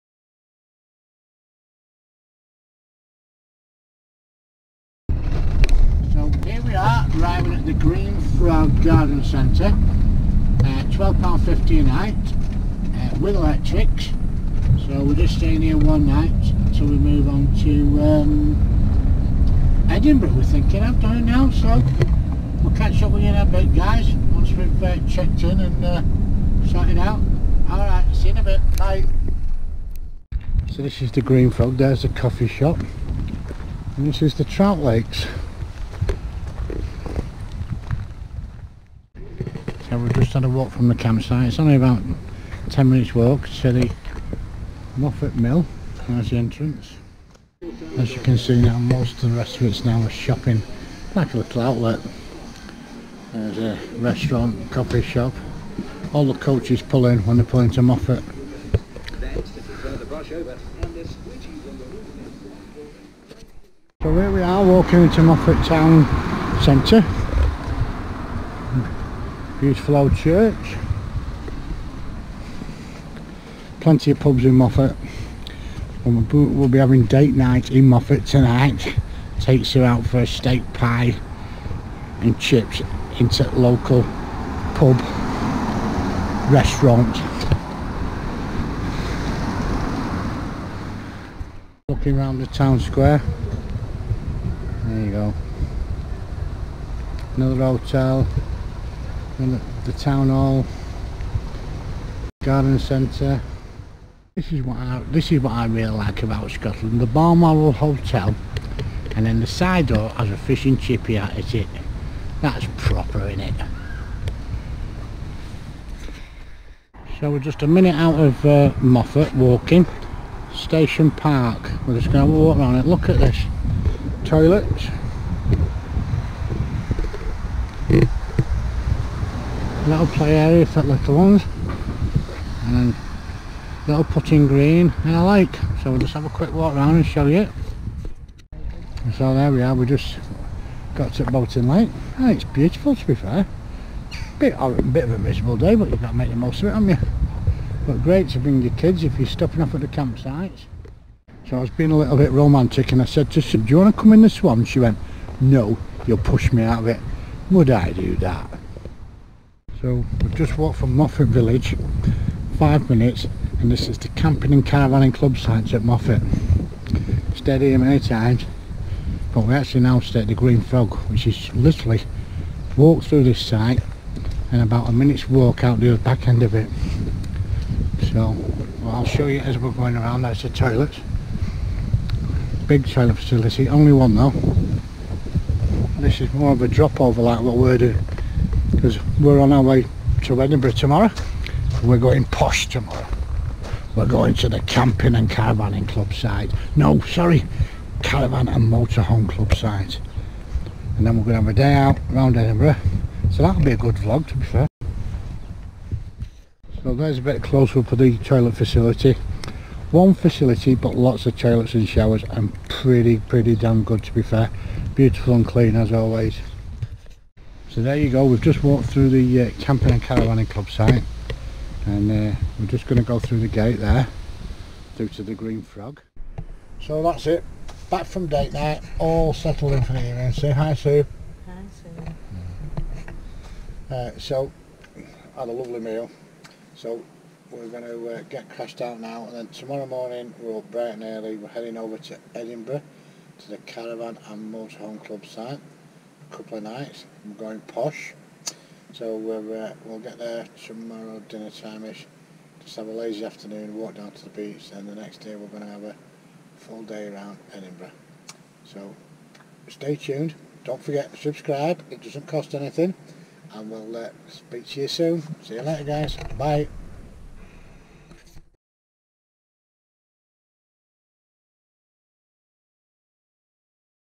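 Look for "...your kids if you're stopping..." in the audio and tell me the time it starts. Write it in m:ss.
2:28.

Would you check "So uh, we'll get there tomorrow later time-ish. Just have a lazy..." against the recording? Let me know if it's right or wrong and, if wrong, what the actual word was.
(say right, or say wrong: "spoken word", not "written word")
wrong: "dinner", not "later".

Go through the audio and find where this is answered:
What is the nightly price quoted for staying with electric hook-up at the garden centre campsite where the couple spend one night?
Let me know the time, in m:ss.
0:10.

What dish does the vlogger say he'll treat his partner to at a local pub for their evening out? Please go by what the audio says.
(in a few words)
Steak pie and chips.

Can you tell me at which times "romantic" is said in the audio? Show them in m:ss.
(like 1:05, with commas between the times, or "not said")
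2:32.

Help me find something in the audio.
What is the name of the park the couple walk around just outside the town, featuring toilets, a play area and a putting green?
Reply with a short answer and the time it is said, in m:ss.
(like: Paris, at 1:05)
Station Park, at 2:00.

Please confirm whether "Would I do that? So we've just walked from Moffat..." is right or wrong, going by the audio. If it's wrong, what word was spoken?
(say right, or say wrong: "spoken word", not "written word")
right.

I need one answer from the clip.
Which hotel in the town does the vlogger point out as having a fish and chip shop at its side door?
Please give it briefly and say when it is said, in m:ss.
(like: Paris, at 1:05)
Balmoral Hotel, at 1:47.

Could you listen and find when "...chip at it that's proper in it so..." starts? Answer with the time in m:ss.
1:50.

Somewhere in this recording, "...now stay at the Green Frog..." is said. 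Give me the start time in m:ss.
2:49.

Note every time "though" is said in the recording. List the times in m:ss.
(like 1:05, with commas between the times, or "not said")
3:04.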